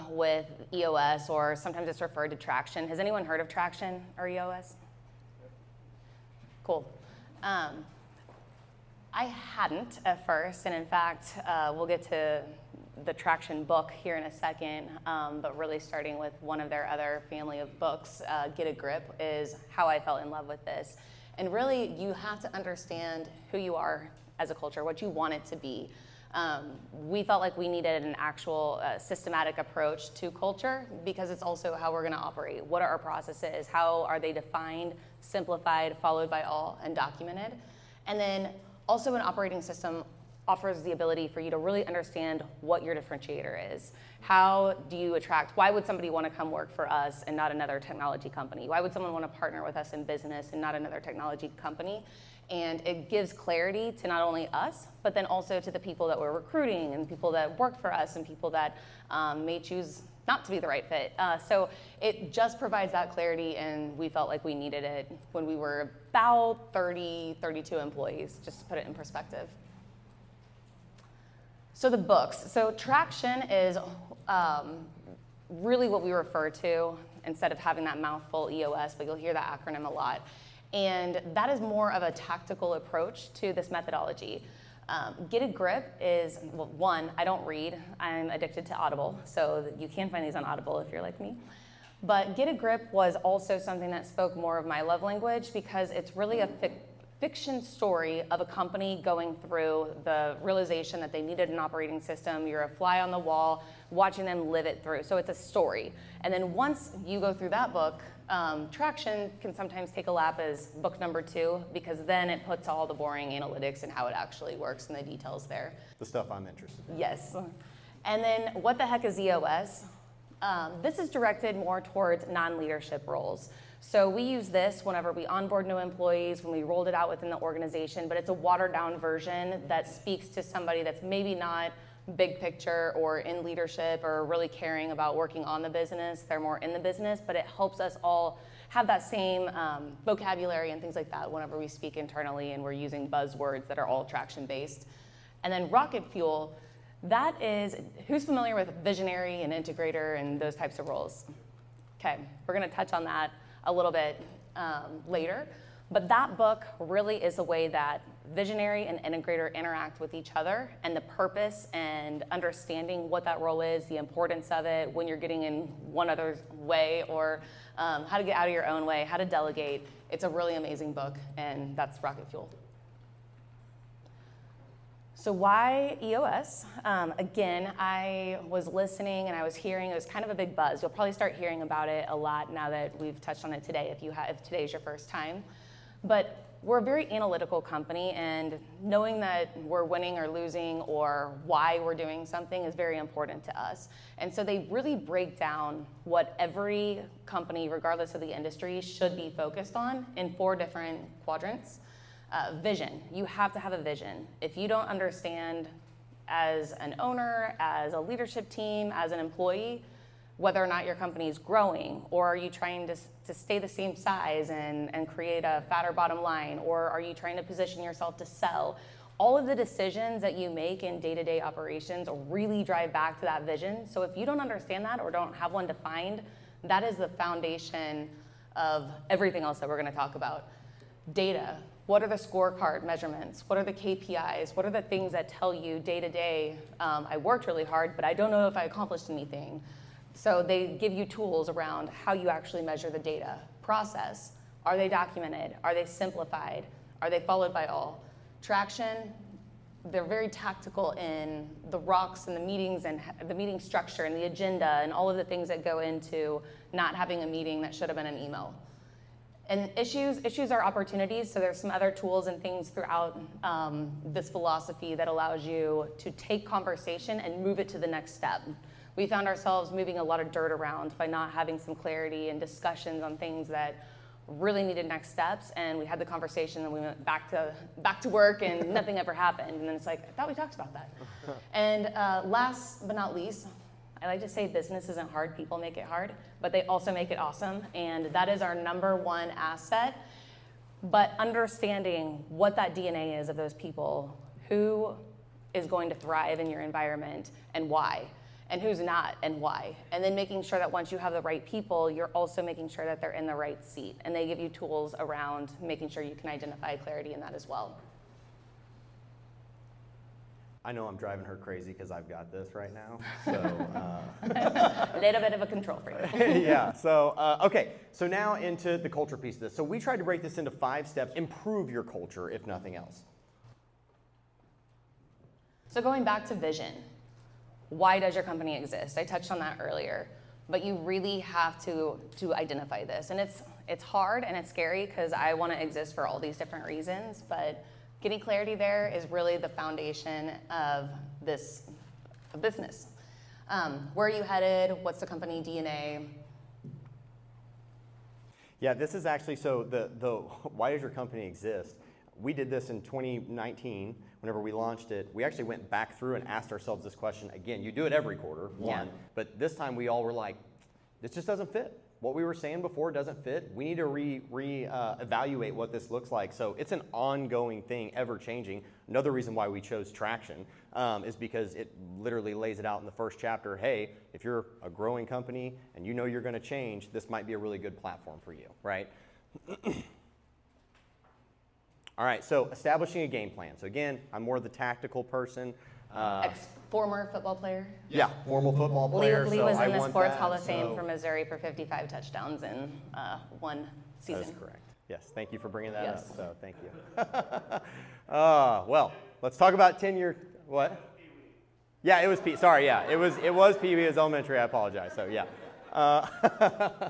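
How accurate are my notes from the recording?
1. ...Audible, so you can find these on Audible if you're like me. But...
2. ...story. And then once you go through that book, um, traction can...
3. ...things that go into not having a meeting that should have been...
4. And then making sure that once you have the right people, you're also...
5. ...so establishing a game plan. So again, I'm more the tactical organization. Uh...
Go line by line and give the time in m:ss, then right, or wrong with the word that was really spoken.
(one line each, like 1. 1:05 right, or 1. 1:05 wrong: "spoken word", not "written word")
1. 1:28 right
2. 1:45 right
3. 4:15 right
4. 4:59 right
5. 6:22 wrong: "person", not "organization".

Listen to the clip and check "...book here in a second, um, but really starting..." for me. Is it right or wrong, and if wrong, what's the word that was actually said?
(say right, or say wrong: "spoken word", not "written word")
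right.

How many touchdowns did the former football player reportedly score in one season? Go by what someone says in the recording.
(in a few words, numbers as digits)
55.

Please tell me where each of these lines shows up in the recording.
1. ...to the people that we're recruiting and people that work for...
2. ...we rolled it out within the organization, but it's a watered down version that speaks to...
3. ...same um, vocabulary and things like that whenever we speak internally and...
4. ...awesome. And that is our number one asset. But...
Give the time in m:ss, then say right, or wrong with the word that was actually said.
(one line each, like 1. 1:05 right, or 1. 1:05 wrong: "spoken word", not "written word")
1. 0:55 right
2. 2:06 right
3. 2:19 right
4. 4:47 right.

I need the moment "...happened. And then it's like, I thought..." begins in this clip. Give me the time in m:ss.
4:39.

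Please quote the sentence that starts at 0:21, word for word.
And really, you have to understand who you are as a culture, what you want it to be.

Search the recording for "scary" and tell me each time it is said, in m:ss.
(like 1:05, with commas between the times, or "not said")
5:34.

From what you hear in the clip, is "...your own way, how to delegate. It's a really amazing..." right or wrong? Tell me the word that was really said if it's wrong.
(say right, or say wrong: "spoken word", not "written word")
right.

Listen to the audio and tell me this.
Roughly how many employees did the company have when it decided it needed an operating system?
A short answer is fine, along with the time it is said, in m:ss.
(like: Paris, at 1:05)
32, at 1:07.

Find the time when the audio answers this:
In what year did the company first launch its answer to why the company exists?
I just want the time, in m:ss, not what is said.
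5:52.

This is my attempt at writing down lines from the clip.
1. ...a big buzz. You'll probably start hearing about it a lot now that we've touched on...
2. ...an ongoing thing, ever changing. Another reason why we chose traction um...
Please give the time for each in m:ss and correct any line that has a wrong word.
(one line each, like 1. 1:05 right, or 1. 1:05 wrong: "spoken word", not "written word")
1. 3:00 right
2. 6:06 right.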